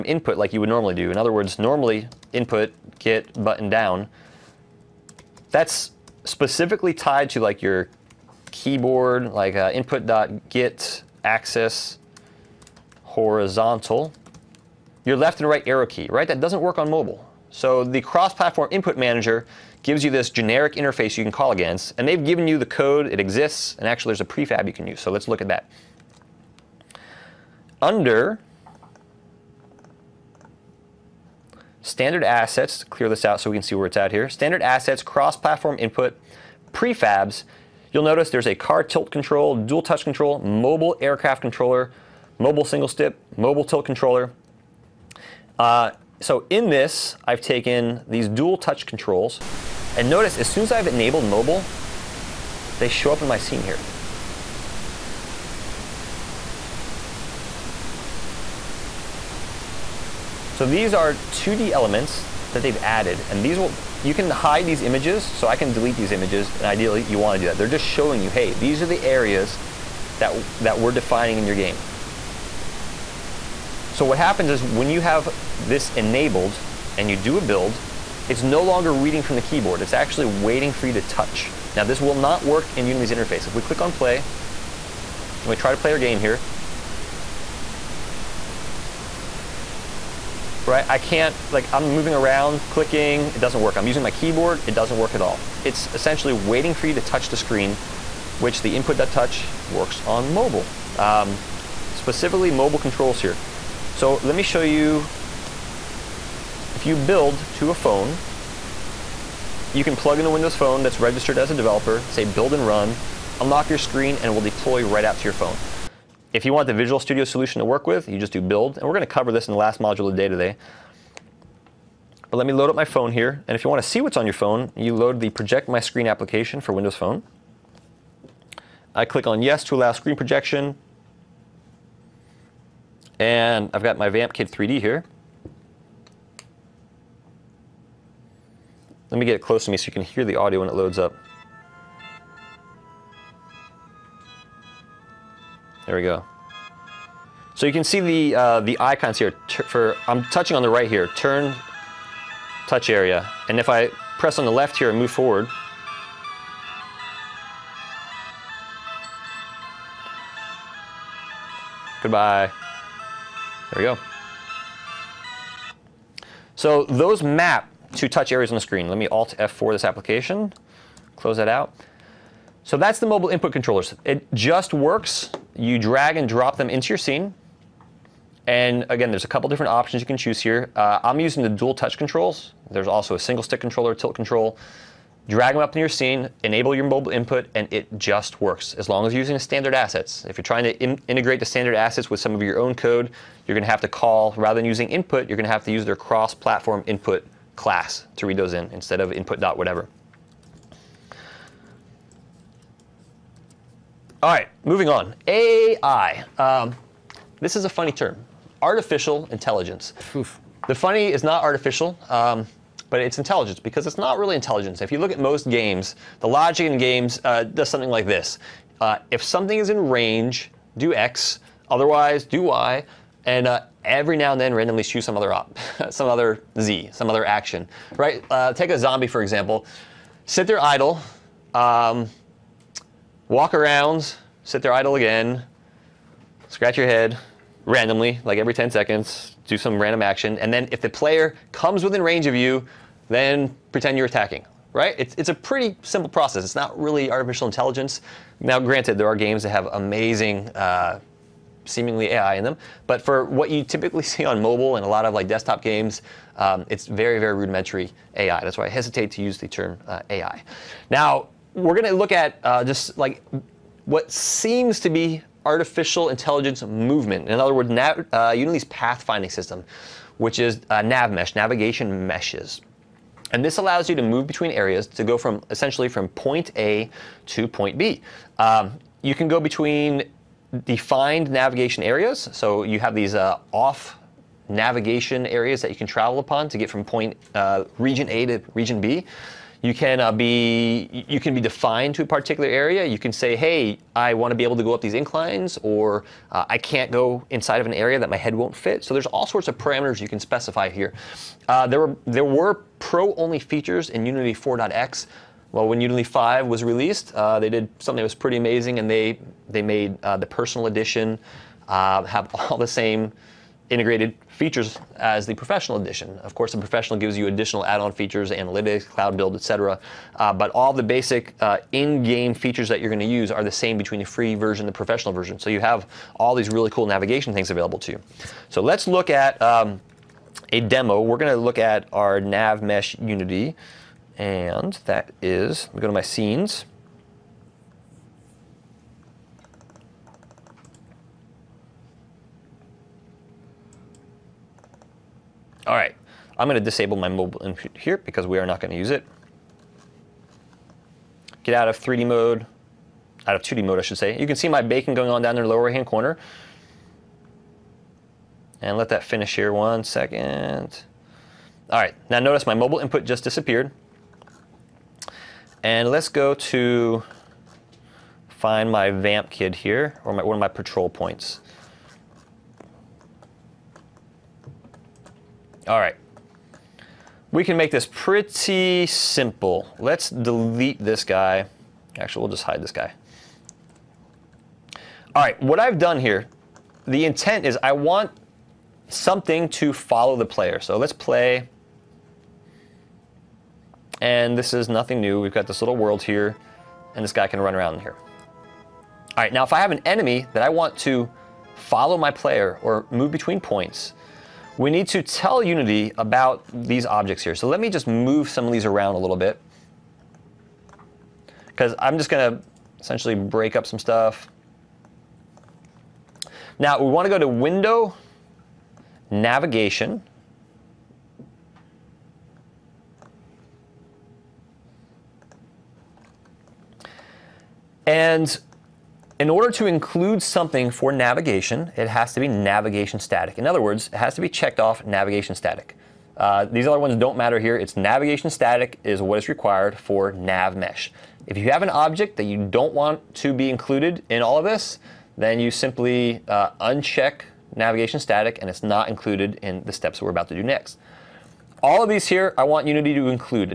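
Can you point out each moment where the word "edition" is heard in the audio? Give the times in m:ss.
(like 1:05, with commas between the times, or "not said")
5:10, 5:15.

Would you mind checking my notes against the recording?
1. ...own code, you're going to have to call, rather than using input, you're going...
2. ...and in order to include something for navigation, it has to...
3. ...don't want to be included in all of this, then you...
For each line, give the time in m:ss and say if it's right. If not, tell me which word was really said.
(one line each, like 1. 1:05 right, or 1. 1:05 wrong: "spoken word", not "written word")
1. 3:12 right
2. 7:07 right
3. 7:22 right.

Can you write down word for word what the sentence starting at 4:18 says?
That's why I hesitate to use the term uh, AI.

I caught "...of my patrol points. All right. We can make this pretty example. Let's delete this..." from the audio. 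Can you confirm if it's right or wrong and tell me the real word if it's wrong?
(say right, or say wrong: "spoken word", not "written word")
wrong: "simple", not "example".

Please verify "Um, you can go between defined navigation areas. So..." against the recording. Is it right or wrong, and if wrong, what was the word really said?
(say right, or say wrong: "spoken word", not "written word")
right.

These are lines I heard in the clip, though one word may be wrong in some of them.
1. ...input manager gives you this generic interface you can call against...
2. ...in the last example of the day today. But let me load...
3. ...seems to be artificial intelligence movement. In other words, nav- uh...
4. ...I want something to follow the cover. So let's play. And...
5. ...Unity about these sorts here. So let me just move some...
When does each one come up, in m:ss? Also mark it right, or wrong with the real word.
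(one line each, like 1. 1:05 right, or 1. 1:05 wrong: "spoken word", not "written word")
1. 0:18 right
2. 1:59 wrong: "module", not "example"
3. 4:24 right
4. 6:27 wrong: "player", not "cover"
5. 6:45 wrong: "objects", not "sorts".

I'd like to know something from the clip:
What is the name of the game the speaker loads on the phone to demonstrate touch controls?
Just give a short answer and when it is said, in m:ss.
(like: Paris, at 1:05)
Vamp Kid 3D, at 2:14.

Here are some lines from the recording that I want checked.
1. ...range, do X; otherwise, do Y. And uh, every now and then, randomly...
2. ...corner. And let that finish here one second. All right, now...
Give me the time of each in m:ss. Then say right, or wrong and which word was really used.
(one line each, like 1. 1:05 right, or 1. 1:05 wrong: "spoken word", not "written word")
1. 3:39 right
2. 5:55 right.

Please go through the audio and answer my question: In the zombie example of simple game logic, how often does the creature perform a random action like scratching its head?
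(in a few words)
Every 10 seconds.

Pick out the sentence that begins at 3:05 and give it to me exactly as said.
Drag them up in your scene, enable your mobile input, and it just works.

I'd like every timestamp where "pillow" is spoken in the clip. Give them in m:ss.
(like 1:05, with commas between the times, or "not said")
not said.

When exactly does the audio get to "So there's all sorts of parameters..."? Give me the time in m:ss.
4:58.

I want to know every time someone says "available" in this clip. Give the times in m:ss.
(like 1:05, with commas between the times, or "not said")
5:27.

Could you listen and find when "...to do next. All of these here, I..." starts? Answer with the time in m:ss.
7:30.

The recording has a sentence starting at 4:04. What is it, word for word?
It's, it's a pretty simple process.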